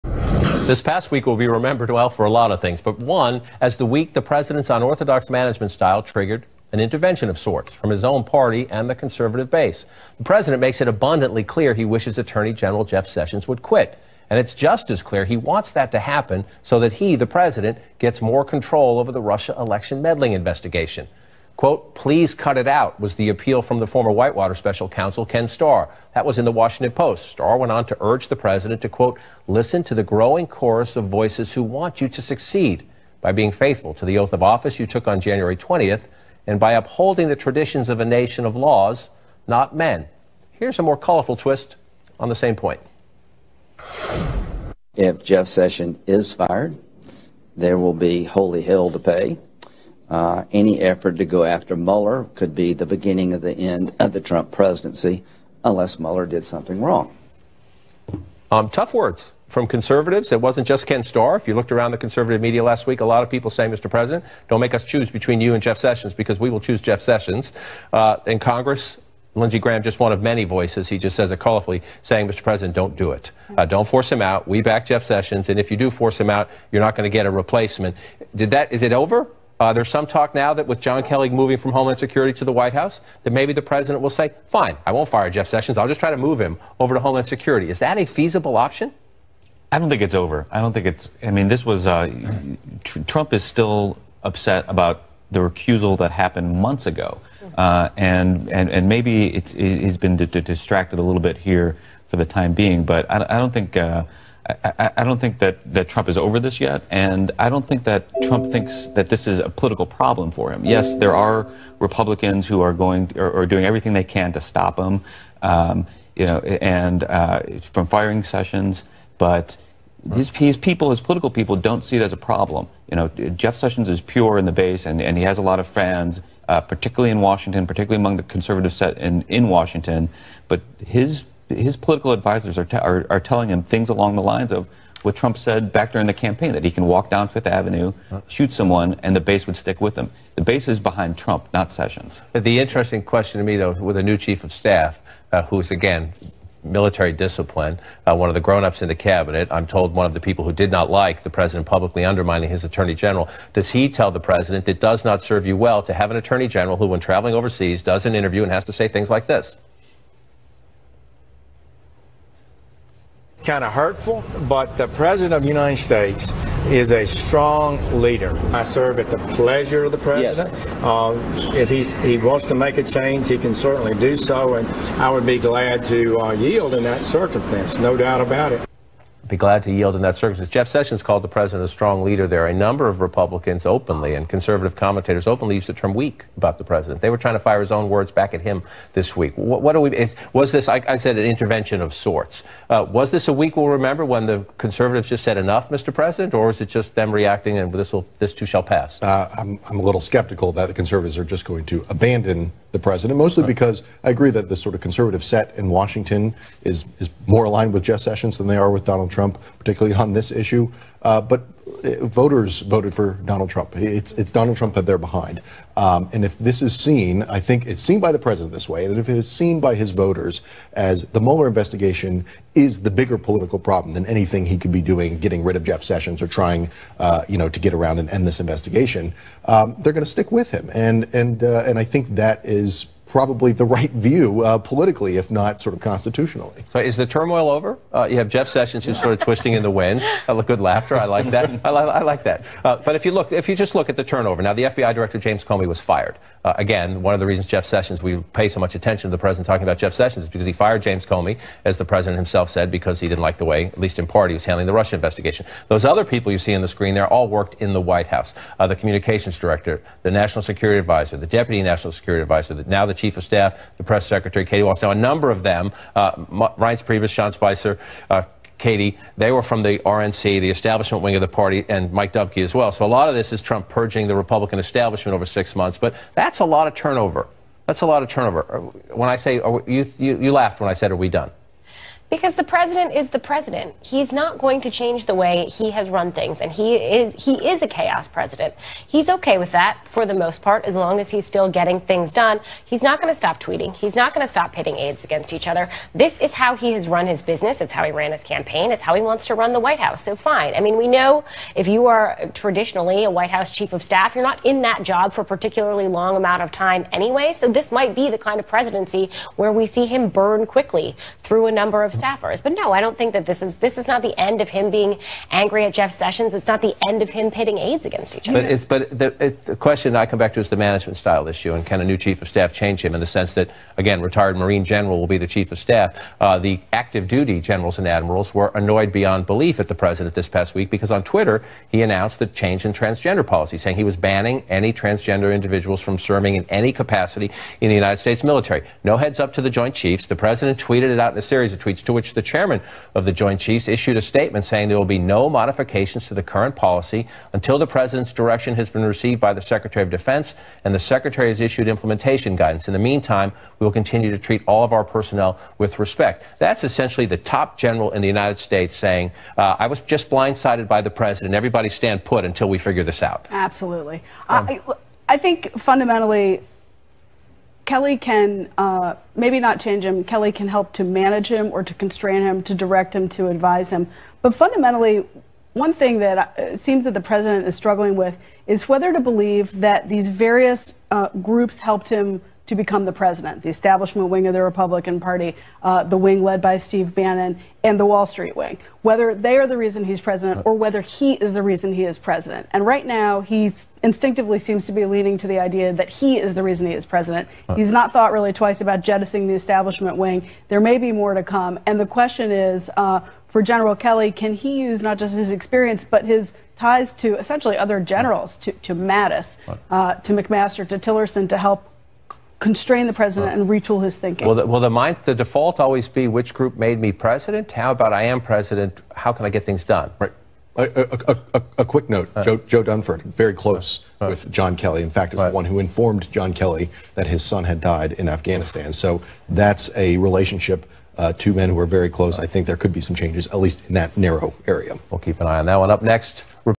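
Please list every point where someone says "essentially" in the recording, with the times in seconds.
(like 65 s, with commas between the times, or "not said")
356 s, 407 s.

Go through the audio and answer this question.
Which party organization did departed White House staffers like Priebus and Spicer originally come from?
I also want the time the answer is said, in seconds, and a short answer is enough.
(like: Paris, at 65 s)
RNC, at 269 s.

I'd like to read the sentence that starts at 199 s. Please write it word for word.
Uh, I'm, I'm a little skeptical that the conservatives are just going to abandon the president, mostly right.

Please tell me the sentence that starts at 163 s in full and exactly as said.
kind of hurtful, but the President of the United States is a strong leader.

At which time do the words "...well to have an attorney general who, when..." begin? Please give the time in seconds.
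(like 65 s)
155 s.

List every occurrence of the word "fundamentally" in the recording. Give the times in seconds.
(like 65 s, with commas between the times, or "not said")
365 s, 374 s.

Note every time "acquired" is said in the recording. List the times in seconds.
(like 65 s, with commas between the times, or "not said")
not said.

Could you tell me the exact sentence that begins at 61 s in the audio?
If you looked around the conservative media last week, a lot of people say, Mr.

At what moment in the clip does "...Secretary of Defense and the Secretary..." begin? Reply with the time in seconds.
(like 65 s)
349 s.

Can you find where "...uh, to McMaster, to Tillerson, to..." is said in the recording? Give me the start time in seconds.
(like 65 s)
409 s.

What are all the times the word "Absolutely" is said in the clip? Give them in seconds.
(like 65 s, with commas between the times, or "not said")
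363 s.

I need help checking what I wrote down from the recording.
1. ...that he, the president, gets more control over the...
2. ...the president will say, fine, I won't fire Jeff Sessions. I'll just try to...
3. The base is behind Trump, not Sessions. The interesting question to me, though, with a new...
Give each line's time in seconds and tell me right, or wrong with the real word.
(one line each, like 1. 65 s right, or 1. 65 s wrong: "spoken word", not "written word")
1. 16 s right
2. 83 s right
3. 140 s right.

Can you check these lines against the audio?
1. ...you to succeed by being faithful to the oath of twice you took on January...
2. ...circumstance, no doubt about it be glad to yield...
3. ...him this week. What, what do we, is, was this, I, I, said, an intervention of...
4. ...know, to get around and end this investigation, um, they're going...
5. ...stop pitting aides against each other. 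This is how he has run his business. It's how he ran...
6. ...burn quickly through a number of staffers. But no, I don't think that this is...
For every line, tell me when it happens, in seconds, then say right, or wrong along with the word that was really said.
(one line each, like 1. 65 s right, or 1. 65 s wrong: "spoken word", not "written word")
1. 32 s wrong: "office", not "twice"
2. 177 s right
3. 188 s right
4. 227 s right
5. 294 s right
6. 310 s right.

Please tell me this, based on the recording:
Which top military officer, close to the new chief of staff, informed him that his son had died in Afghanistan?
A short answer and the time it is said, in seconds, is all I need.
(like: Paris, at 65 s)
Joe Dunford, at 422 s.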